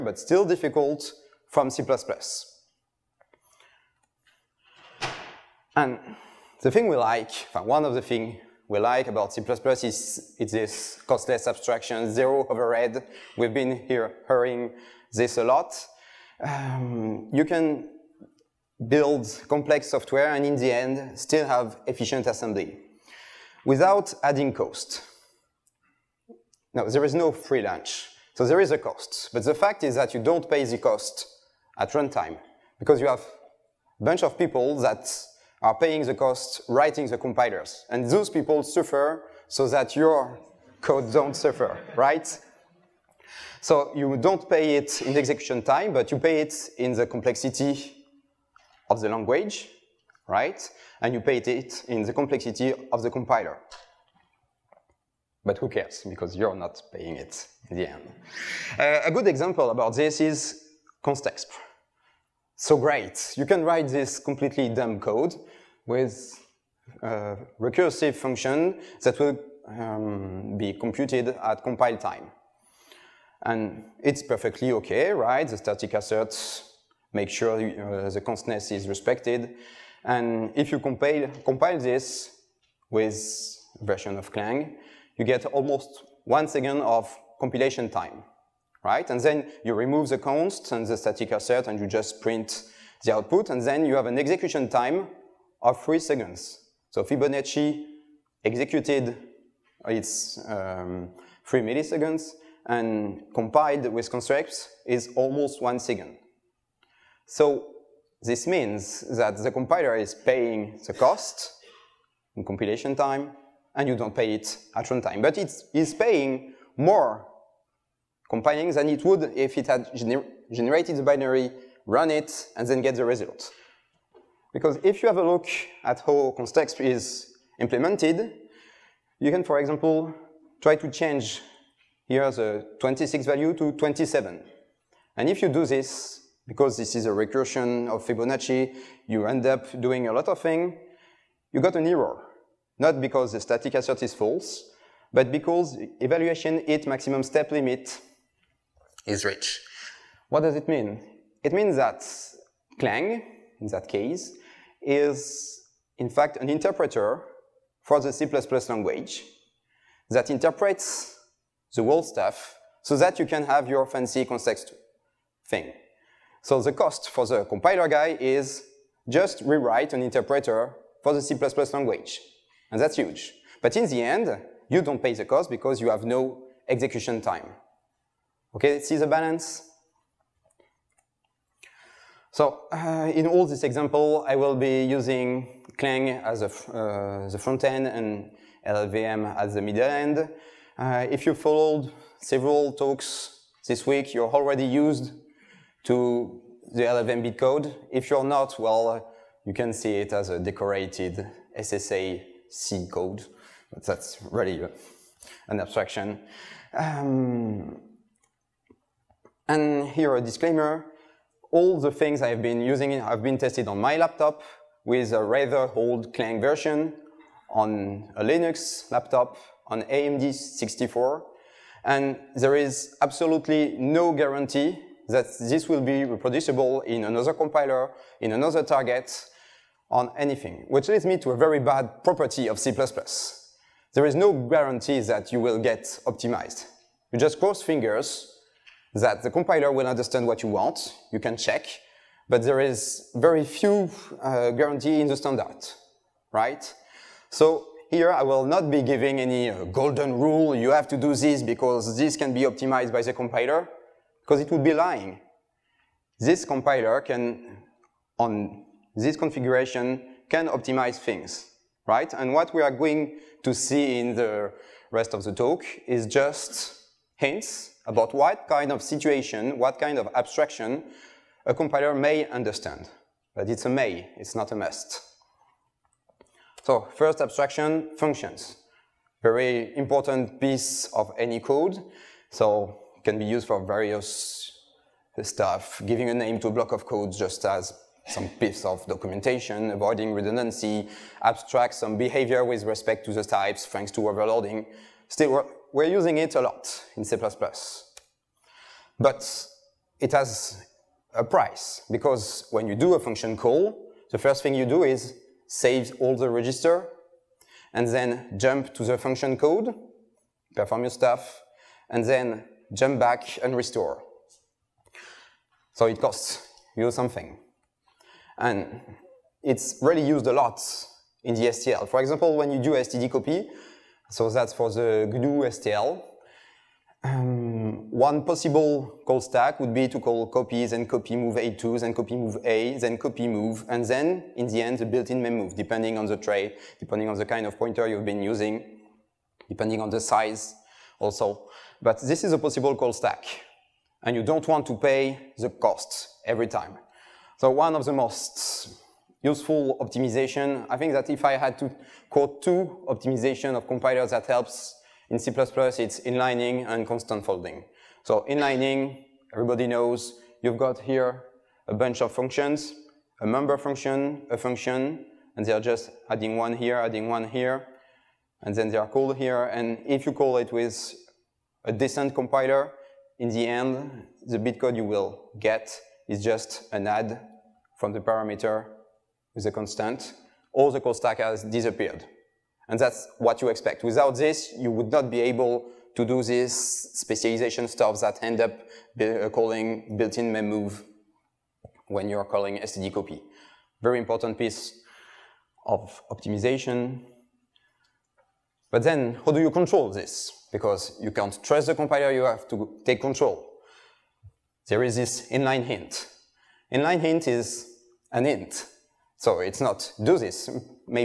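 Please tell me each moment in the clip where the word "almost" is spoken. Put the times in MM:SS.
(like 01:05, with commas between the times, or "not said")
01:25, 01:45.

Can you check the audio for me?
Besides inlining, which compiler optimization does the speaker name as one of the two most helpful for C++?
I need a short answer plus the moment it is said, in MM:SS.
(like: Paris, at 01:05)
constant folding, at 05:56.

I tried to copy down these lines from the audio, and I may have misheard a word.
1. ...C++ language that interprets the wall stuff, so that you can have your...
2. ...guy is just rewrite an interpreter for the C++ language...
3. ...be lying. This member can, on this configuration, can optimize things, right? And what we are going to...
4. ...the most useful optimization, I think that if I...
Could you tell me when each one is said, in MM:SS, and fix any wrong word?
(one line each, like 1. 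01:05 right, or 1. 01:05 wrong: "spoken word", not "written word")
1. 02:38 right
2. 02:47 right
3. 04:14 wrong: "compiler", not "member"
4. 05:47 right.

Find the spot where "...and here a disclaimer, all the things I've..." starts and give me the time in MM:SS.
03:29.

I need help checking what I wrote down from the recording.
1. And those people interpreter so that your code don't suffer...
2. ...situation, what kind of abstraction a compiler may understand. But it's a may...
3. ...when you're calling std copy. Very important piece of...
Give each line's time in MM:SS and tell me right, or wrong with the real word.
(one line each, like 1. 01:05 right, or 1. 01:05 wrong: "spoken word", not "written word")
1. 00:37 wrong: "suffer", not "interpreter"
2. 04:28 right
3. 06:31 right.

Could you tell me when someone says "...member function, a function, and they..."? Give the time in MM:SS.
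06:03.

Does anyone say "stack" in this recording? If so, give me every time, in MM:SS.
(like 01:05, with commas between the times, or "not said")
05:29, 05:42, 06:20.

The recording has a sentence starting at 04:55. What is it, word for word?
Still, we're using it a lot in C++.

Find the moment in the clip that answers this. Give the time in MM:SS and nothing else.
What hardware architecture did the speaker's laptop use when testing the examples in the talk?
03:39.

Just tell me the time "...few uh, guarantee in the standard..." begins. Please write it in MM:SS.
04:03.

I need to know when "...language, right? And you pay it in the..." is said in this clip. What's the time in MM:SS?
00:49.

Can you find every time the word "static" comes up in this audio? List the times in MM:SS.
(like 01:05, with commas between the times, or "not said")
01:15, 01:30, 02:23.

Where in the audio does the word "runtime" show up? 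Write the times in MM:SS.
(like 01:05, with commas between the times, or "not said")
00:31, 01:54.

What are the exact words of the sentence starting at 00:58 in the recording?
Uh, a good example about this is constexpr.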